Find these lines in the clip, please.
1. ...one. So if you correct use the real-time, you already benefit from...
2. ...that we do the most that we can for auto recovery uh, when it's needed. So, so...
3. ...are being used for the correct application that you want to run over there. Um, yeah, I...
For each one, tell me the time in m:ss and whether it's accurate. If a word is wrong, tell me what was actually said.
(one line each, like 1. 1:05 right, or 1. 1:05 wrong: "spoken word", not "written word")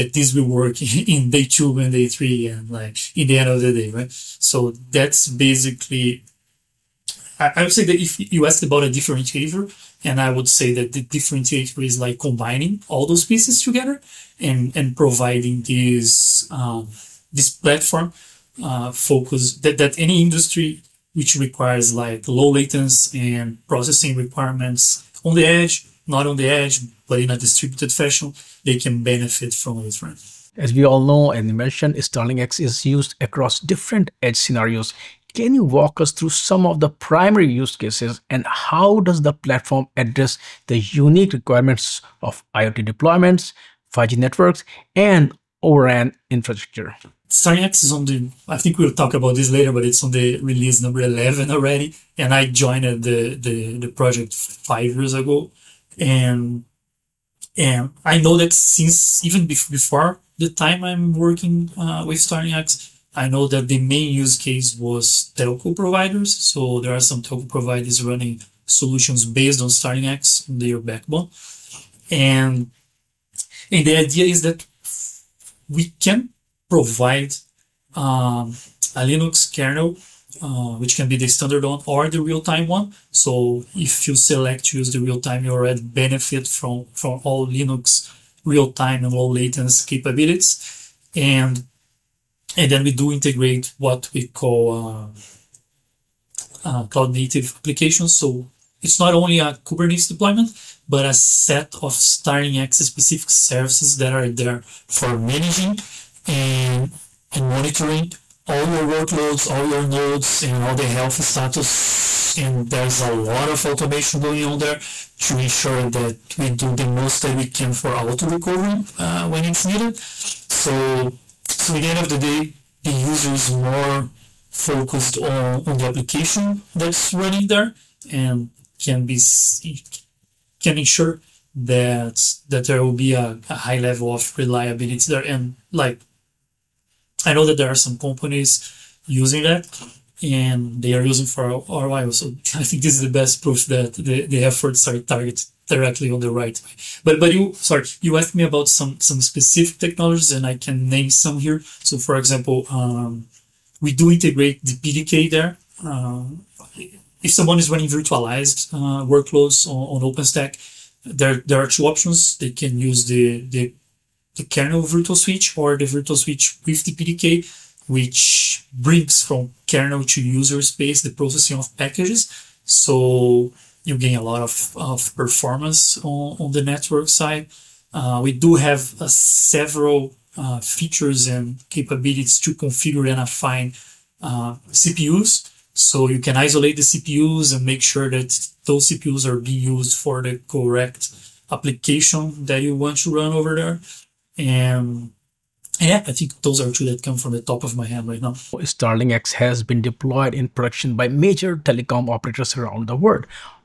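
1. 1:22 wrong: "select", not "correct"
2. 1:55 right
3. 3:09 right.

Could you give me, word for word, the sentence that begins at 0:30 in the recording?
As we all know, and mentioned, StarlingX is used across different edge scenarios.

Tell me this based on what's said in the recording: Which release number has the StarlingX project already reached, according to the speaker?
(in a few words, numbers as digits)
11.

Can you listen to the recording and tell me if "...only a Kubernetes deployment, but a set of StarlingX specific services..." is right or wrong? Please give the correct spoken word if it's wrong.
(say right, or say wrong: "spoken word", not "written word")
right.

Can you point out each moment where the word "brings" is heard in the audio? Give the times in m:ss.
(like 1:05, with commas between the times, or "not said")
2:48.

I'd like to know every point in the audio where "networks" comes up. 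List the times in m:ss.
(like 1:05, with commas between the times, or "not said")
0:44, 2:56.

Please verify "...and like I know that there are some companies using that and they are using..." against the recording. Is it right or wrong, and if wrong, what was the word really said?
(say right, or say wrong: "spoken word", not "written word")
right.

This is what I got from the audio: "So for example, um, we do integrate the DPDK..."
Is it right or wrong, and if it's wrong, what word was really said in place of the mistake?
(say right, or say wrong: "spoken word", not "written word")
right.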